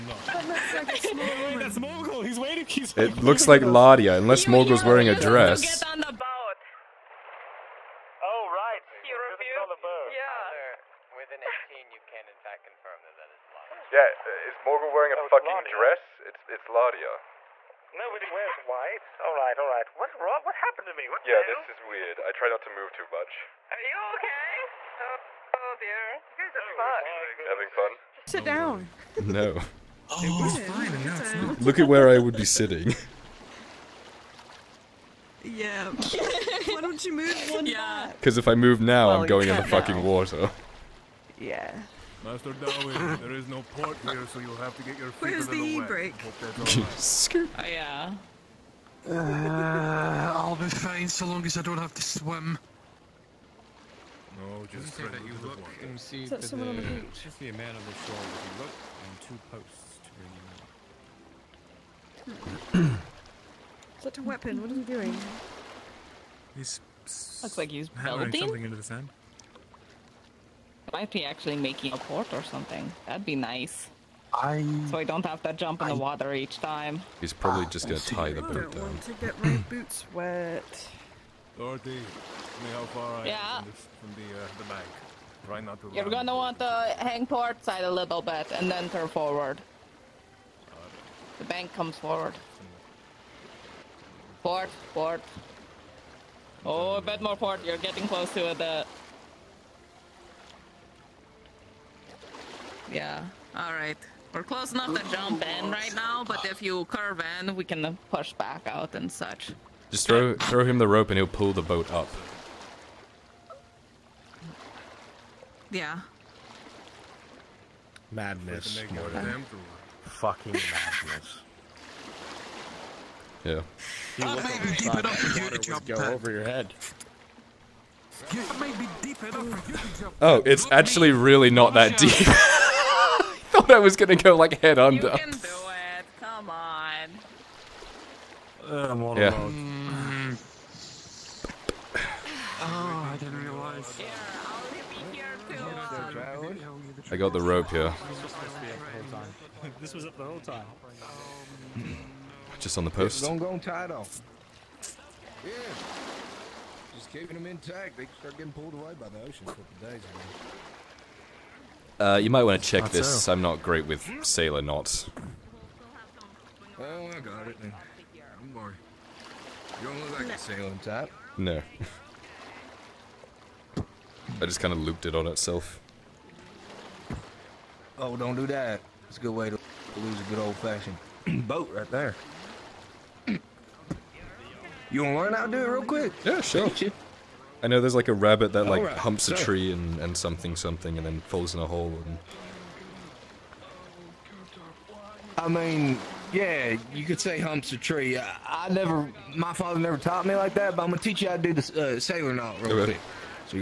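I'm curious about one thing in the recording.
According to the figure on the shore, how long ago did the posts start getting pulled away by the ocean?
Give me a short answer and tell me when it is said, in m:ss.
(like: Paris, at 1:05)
a couple days ago, at 2:39.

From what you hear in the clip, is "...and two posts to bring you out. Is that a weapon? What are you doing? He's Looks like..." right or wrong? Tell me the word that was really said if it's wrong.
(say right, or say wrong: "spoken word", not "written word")
right.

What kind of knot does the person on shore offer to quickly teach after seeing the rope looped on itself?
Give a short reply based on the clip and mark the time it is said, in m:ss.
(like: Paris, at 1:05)
sailor knot, at 3:21.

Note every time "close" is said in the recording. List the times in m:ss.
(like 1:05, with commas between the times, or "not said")
1:38, 1:44.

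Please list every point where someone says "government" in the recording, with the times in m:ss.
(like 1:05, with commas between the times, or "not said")
not said.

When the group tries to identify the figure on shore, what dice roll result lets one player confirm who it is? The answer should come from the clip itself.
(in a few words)
18.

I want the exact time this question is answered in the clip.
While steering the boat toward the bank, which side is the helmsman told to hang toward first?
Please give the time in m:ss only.
1:27.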